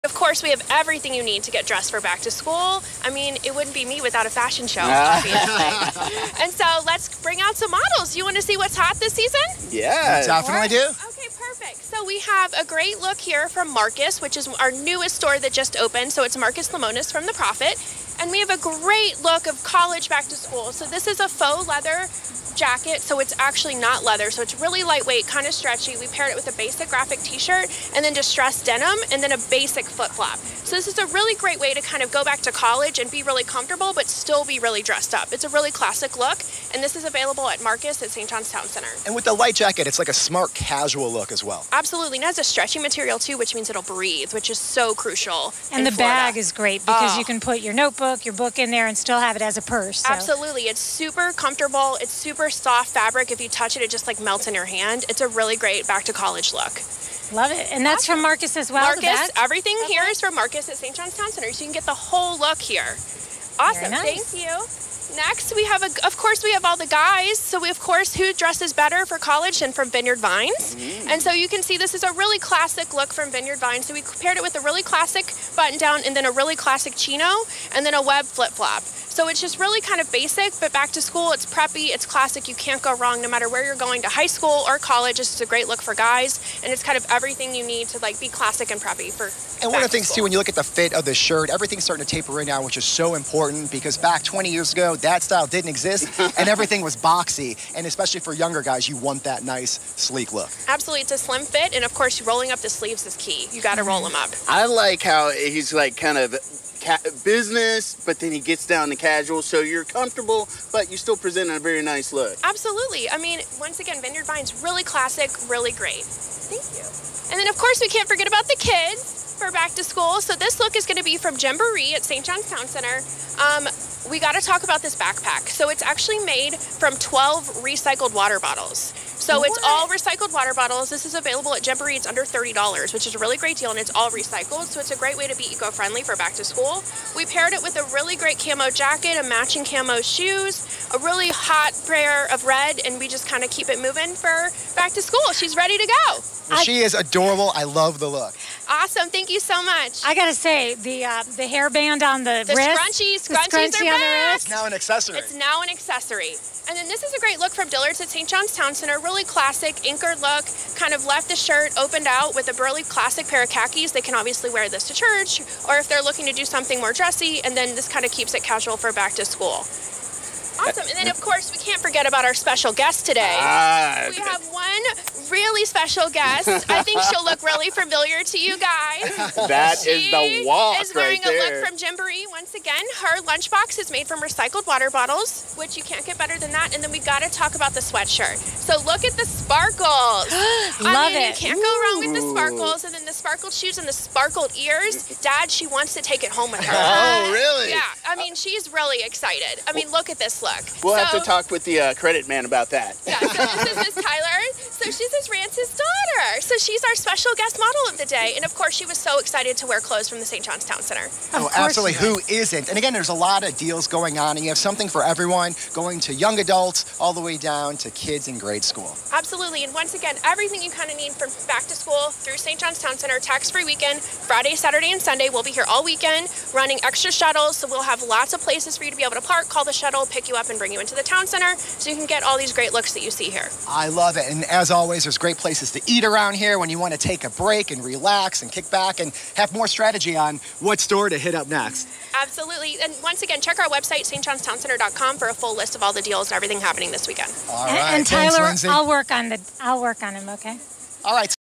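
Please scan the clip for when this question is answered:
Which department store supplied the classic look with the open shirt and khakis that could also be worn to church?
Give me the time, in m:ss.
2:37.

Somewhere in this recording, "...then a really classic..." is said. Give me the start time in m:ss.
1:16.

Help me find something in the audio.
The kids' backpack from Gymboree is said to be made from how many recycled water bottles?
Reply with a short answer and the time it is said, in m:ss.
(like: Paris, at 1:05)
12, at 2:06.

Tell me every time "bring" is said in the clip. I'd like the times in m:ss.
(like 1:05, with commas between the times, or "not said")
0:07, 3:50.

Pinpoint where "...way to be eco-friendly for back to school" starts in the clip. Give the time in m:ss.
2:15.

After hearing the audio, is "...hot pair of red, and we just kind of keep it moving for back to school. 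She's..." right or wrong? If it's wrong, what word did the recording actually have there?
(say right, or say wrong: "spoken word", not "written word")
right.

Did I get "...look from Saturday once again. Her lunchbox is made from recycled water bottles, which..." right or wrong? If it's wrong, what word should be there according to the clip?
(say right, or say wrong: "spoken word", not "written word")
wrong: "Gymboree", not "Saturday".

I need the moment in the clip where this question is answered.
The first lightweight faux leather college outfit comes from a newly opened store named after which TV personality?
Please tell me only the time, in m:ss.
0:16.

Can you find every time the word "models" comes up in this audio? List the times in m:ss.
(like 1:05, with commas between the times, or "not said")
0:07, 3:27.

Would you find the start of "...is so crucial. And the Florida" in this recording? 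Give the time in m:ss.
0:44.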